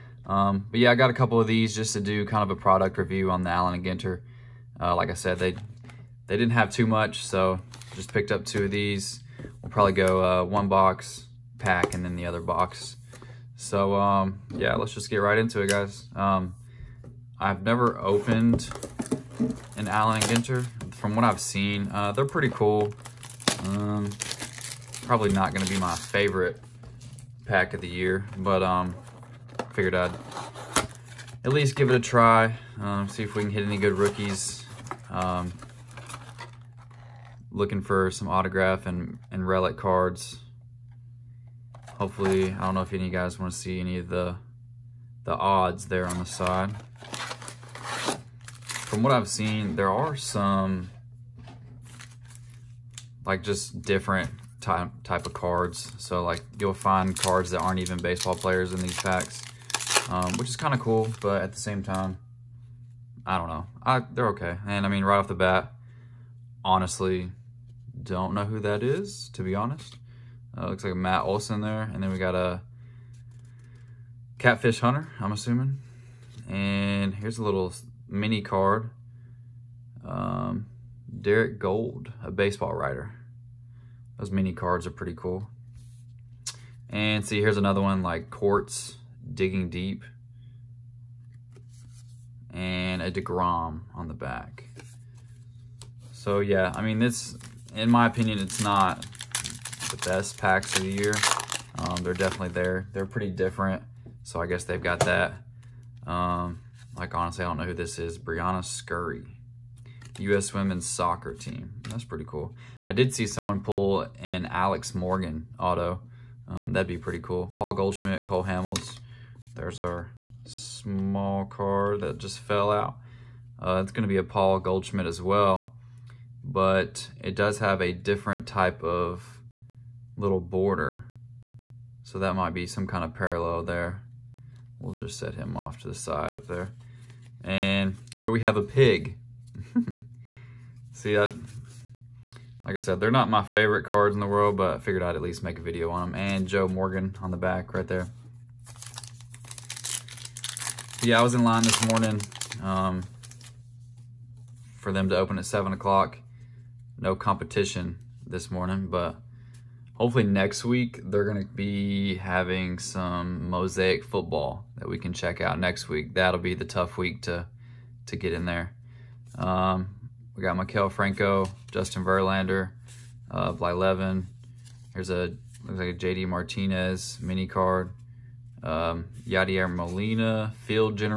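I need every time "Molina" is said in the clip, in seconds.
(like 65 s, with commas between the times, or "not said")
179 s.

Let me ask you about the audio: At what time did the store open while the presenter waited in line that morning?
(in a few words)
7 o'clock.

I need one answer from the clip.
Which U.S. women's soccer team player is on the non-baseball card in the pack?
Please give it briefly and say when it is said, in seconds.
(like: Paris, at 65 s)
Briana Scurry, at 108 s.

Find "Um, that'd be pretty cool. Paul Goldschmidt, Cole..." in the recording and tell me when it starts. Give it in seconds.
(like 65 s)
116 s.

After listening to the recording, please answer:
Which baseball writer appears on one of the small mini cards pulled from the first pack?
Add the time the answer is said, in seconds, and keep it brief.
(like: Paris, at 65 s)
Derrick Goold, at 81 s.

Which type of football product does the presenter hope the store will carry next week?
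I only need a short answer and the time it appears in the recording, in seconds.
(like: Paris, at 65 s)
Mosaic, at 163 s.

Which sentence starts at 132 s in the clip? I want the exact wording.
So that might be some kind of parallel there.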